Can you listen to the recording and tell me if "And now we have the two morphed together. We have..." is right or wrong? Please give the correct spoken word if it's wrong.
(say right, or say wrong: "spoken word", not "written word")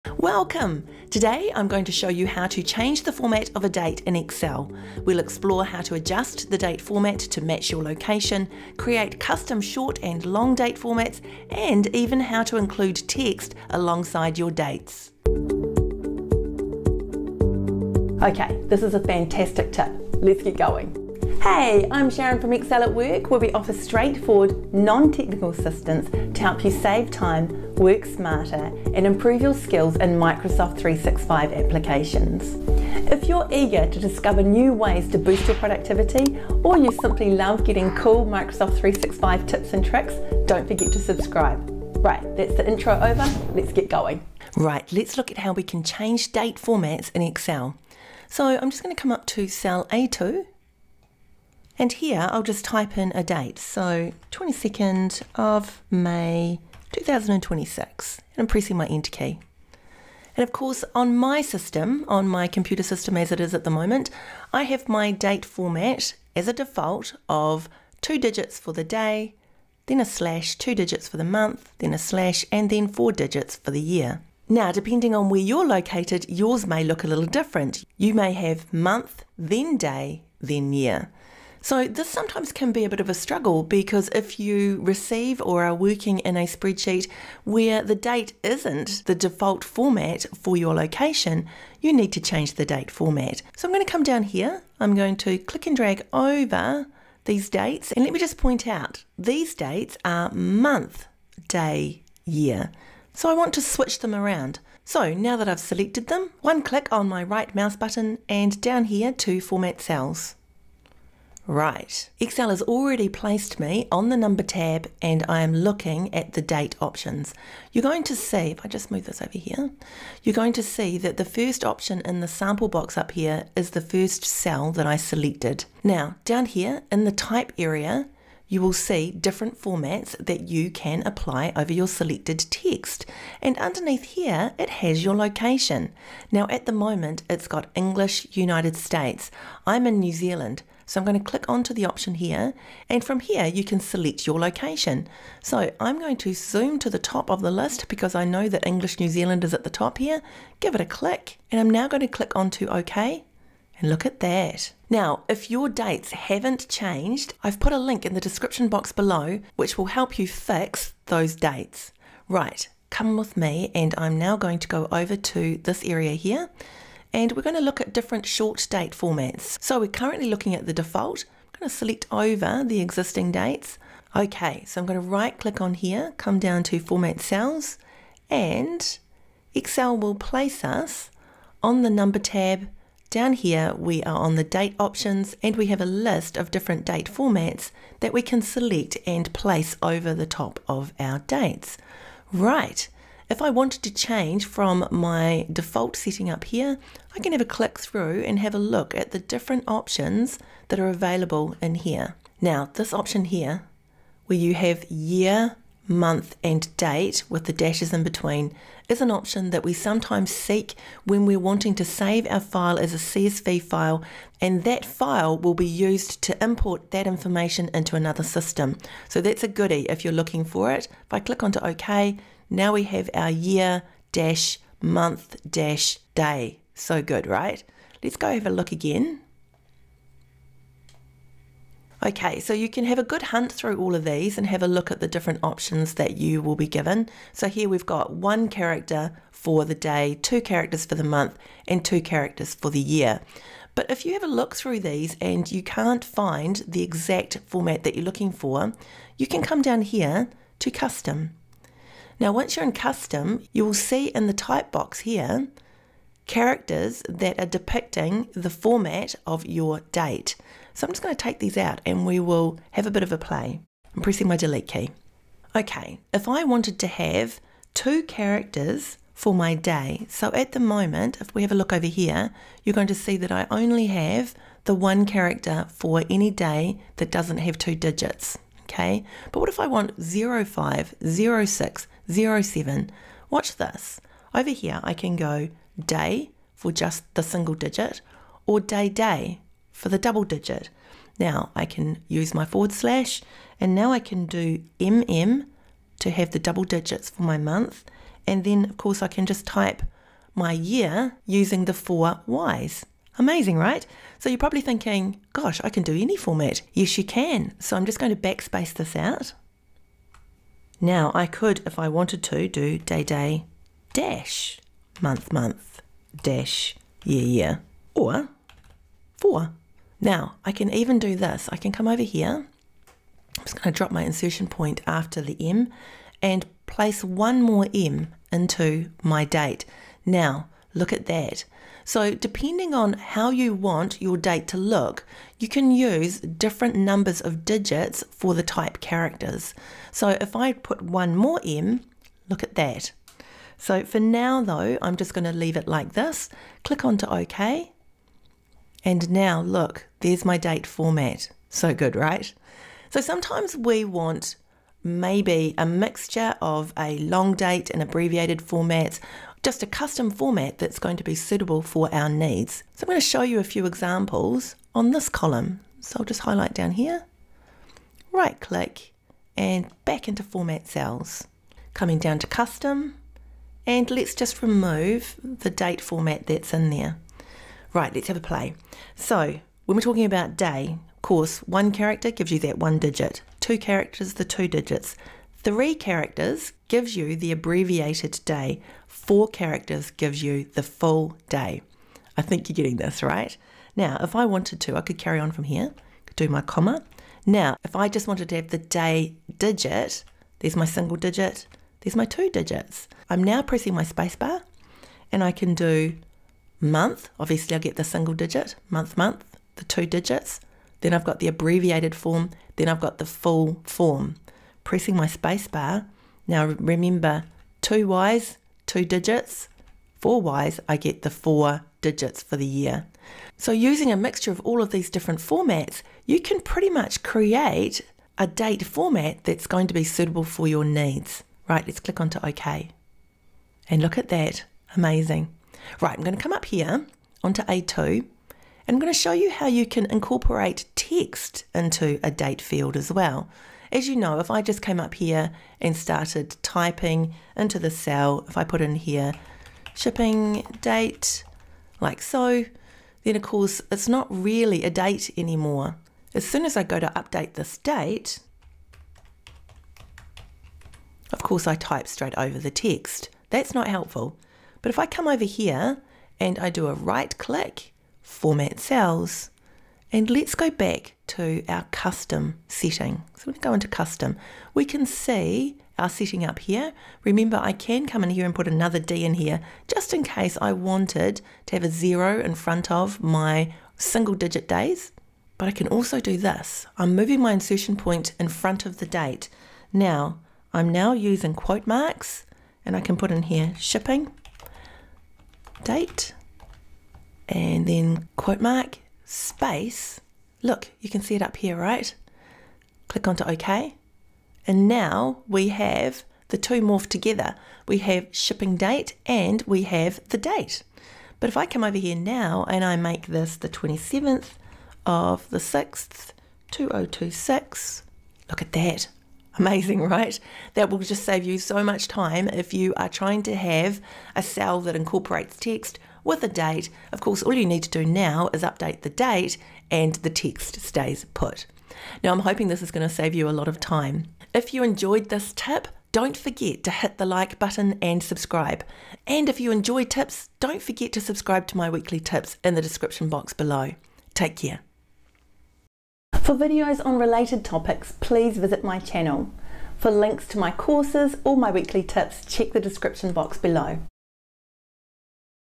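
right.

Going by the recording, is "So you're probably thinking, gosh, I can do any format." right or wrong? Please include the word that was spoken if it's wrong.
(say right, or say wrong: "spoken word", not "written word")
right.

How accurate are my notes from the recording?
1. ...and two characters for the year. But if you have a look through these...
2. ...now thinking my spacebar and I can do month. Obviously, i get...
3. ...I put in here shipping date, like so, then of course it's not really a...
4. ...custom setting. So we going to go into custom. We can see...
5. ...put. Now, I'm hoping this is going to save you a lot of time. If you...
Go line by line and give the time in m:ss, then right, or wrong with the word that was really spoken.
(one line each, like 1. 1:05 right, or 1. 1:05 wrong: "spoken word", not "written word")
1. 4:01 right
2. 6:43 wrong: "pressing", not "thinking"
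3. 7:28 right
4. 7:51 right
5. 8:51 right.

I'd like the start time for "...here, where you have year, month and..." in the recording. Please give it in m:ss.
3:23.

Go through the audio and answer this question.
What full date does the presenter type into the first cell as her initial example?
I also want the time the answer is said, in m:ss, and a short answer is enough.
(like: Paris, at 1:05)
22 May 2026, at 0:54.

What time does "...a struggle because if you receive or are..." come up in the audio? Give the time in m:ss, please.
1:23.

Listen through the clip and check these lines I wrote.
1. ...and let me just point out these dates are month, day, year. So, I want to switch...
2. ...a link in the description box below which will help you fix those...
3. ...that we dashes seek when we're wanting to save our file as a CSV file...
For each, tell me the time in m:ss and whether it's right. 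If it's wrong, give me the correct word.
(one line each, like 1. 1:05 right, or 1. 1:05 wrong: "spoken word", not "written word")
1. 1:37 right
2. 2:37 right
3. 3:29 wrong: "sometimes", not "dashes".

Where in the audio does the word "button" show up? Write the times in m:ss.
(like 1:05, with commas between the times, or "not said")
1:47, 8:57.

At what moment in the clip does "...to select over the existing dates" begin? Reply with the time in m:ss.
2:51.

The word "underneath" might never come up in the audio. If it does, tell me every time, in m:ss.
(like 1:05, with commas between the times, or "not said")
2:13.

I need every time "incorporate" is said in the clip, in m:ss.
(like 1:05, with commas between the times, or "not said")
7:19, 8:44.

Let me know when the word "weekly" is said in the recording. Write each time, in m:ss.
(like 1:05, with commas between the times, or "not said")
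9:01, 9:11.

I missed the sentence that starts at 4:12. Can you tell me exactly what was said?
Now, once you're in custom, you will see in the type box here characters that are depicting the format of your date.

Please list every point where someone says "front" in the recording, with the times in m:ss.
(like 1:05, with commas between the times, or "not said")
8:02, 8:08.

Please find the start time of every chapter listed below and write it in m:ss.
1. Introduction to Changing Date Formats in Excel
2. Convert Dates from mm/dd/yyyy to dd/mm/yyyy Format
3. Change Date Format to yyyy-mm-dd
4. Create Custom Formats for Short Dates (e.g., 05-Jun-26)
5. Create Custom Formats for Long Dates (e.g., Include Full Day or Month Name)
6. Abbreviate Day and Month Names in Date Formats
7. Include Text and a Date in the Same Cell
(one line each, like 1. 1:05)
1. 0:44
2. 1:20
3. 2:54
4. 3:56
5. 6:06
6. 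6:17
7. 7:18.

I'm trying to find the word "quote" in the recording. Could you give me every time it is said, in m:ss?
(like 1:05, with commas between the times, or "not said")
8:11, 8:18.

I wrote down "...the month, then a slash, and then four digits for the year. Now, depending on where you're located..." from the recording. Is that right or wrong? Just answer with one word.
right.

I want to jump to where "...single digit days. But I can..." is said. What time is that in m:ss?
8:03.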